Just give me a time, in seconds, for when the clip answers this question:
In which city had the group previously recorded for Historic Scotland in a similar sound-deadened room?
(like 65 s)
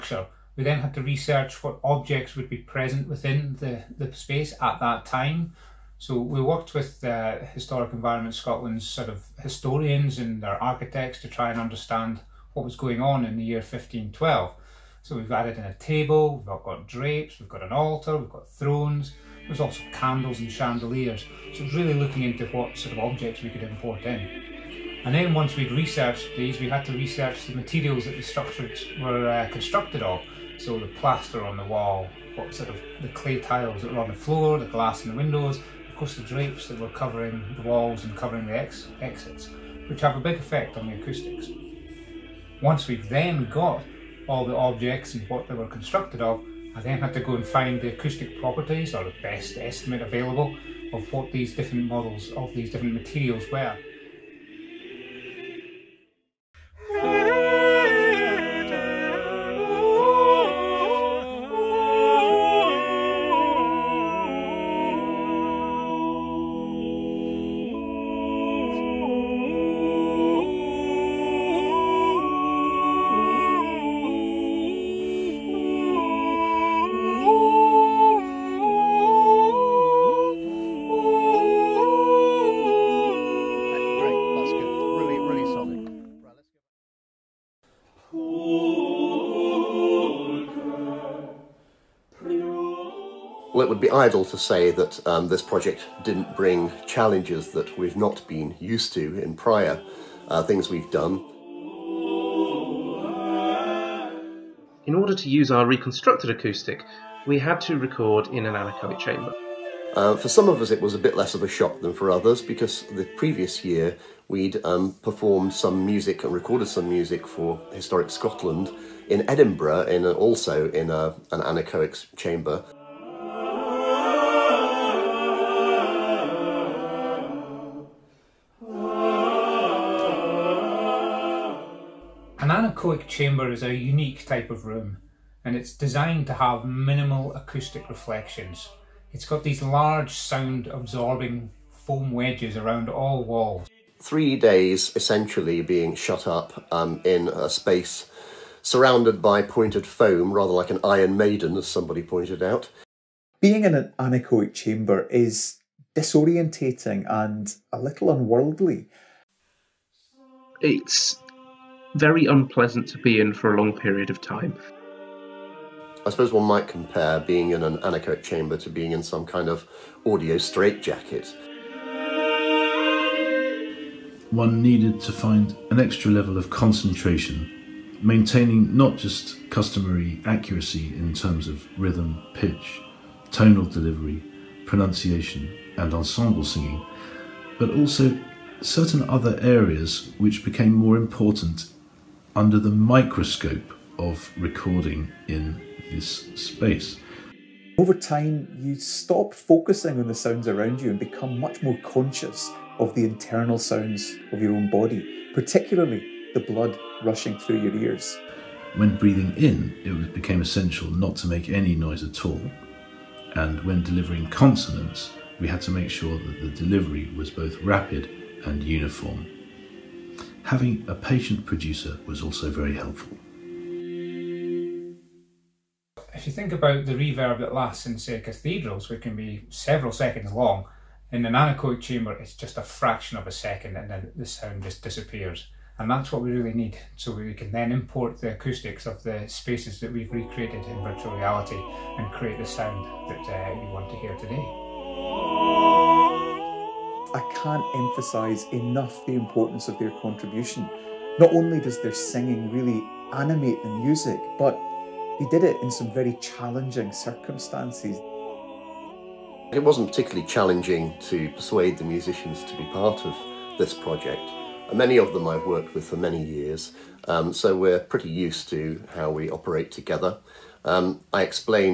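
119 s.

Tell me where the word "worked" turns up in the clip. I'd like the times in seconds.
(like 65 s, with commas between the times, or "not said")
6 s, 265 s.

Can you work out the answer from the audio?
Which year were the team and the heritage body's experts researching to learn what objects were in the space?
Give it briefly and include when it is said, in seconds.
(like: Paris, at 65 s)
1512, at 13 s.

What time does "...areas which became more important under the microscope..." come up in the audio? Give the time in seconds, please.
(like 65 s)
189 s.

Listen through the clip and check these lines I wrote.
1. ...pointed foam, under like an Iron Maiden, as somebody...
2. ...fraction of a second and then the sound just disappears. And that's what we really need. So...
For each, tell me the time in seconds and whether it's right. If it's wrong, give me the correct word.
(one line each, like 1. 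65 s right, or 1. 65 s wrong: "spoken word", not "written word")
1. 149 s wrong: "rather", not "under"
2. 232 s right.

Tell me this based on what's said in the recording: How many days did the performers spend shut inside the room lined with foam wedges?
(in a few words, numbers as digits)
3.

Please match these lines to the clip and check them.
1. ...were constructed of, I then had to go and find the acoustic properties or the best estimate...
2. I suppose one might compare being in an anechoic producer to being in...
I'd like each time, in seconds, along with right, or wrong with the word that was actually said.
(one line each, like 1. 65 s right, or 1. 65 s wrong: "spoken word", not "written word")
1. 45 s right
2. 166 s wrong: "chamber", not "producer".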